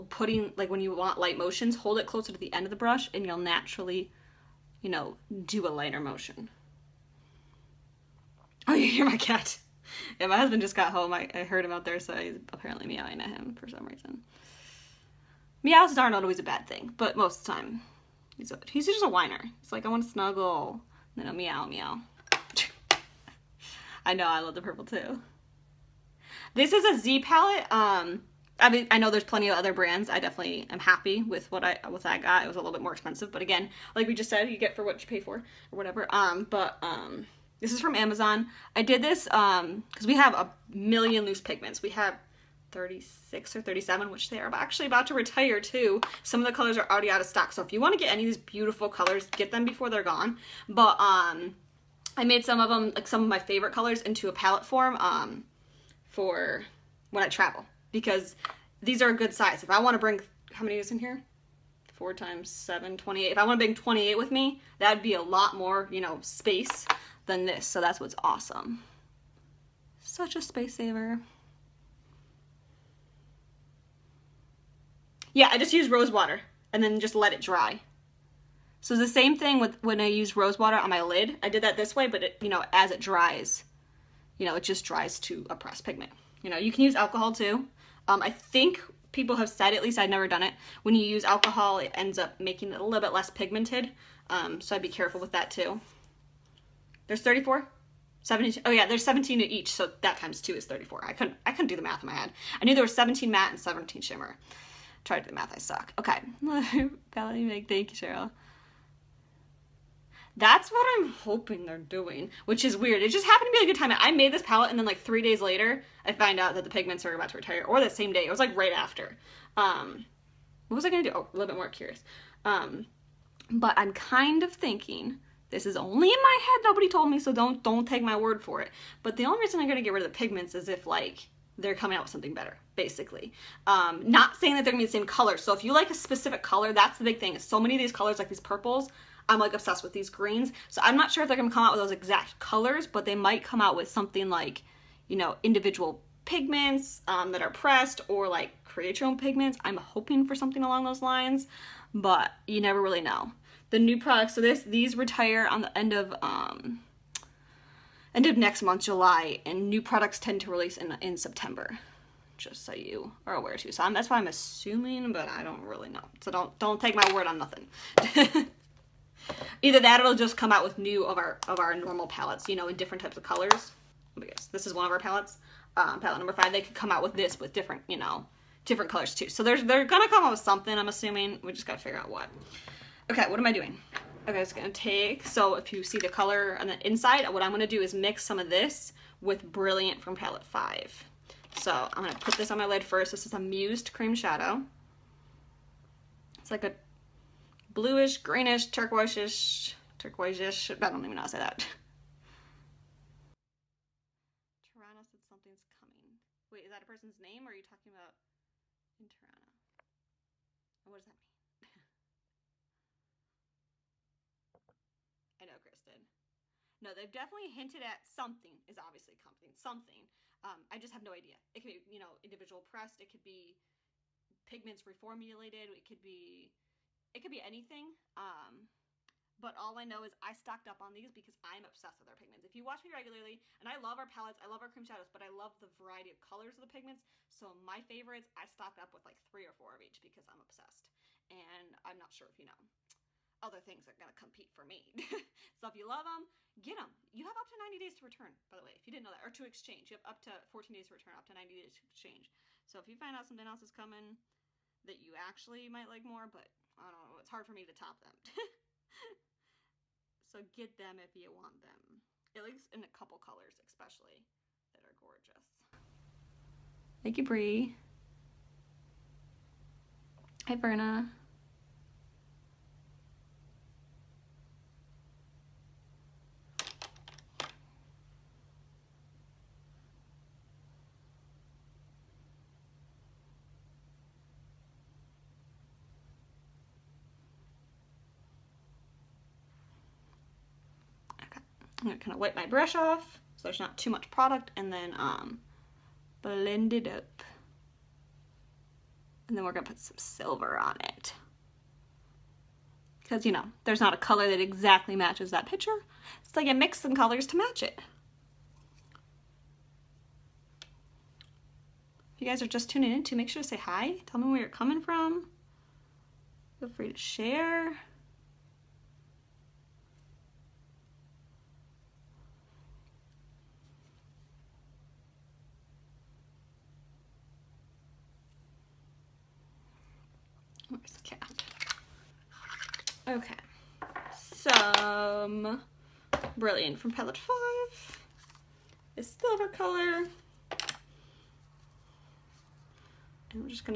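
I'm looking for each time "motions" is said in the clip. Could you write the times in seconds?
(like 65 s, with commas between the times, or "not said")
1 s, 5 s.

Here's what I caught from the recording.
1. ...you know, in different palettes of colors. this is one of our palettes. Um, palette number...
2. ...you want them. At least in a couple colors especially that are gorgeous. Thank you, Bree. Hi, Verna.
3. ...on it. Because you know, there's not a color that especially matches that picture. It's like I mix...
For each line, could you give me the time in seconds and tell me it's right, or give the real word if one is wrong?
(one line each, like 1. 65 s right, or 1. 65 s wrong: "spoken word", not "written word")
1. 172 s wrong: "types", not "palettes"
2. 261 s right
3. 300 s wrong: "exactly", not "especially".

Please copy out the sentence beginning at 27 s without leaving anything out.
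Um, I mean, I know there's plenty of other brands.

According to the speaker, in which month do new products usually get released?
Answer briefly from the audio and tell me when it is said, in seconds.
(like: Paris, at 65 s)
September, at 161 s.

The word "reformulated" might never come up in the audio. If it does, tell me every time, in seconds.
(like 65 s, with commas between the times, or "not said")
224 s.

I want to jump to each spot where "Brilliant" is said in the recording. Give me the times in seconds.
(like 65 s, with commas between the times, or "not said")
189 s, 336 s.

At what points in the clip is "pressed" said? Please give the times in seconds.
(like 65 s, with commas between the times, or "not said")
85 s, 147 s, 222 s.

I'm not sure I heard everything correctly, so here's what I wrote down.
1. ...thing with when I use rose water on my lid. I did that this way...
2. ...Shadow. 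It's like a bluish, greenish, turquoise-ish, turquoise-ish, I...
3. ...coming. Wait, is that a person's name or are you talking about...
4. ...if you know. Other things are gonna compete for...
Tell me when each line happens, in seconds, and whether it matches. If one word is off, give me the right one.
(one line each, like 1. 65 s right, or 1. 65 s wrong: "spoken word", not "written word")
1. 79 s right
2. 194 s right
3. 205 s right
4. 242 s right.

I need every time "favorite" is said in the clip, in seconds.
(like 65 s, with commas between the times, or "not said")
53 s, 237 s.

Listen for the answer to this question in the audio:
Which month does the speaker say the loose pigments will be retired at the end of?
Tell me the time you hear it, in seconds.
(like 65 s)
158 s.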